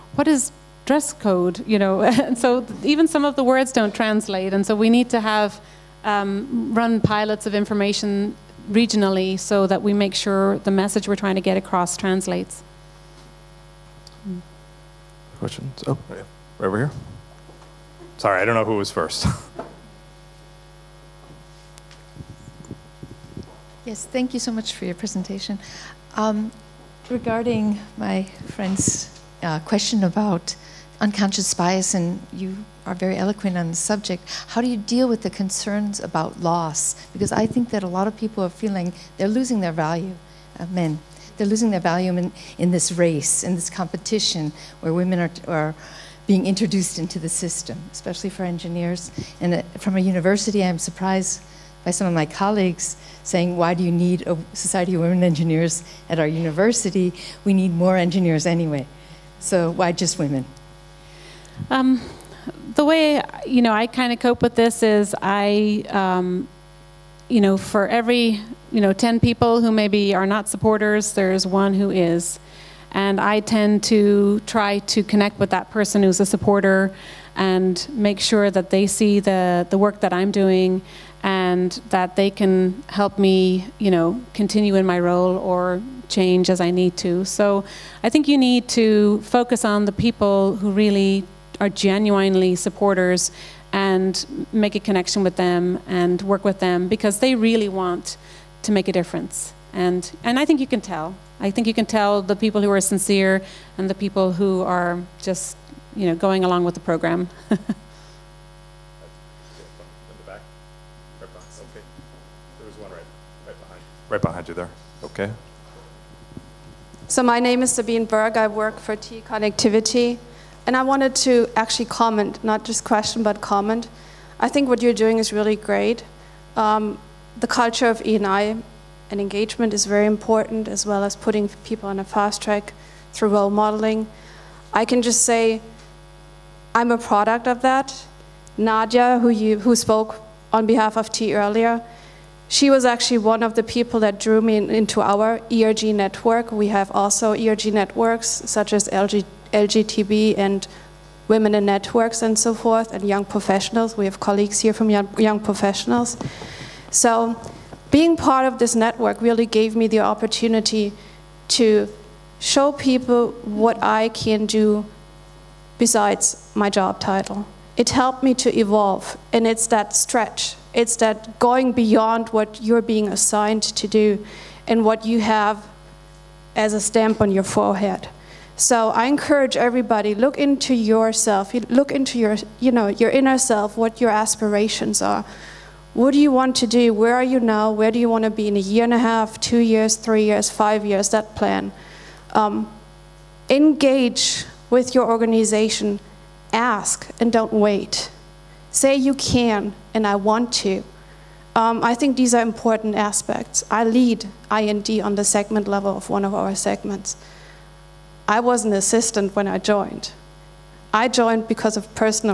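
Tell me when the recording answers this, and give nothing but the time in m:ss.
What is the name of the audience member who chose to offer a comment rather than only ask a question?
1:57.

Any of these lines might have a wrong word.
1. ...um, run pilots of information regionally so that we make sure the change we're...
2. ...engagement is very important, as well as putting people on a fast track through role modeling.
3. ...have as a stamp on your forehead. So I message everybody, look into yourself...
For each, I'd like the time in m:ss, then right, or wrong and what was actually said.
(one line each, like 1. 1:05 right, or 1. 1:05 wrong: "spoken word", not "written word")
1. 0:06 wrong: "message", not "change"
2. 2:09 right
3. 2:55 wrong: "encourage", not "message".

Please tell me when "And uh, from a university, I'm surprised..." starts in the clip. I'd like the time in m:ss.
0:49.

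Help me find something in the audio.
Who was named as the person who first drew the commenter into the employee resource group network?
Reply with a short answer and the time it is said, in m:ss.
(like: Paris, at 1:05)
Nadia, at 2:18.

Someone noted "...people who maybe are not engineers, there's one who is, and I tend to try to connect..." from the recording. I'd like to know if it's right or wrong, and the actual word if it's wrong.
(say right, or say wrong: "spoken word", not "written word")
wrong: "supporters", not "engineers".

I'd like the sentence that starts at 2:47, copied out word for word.
It helped me to evolve, and it's that stretch.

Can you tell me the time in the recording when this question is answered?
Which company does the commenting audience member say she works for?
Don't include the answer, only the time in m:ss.
1:58.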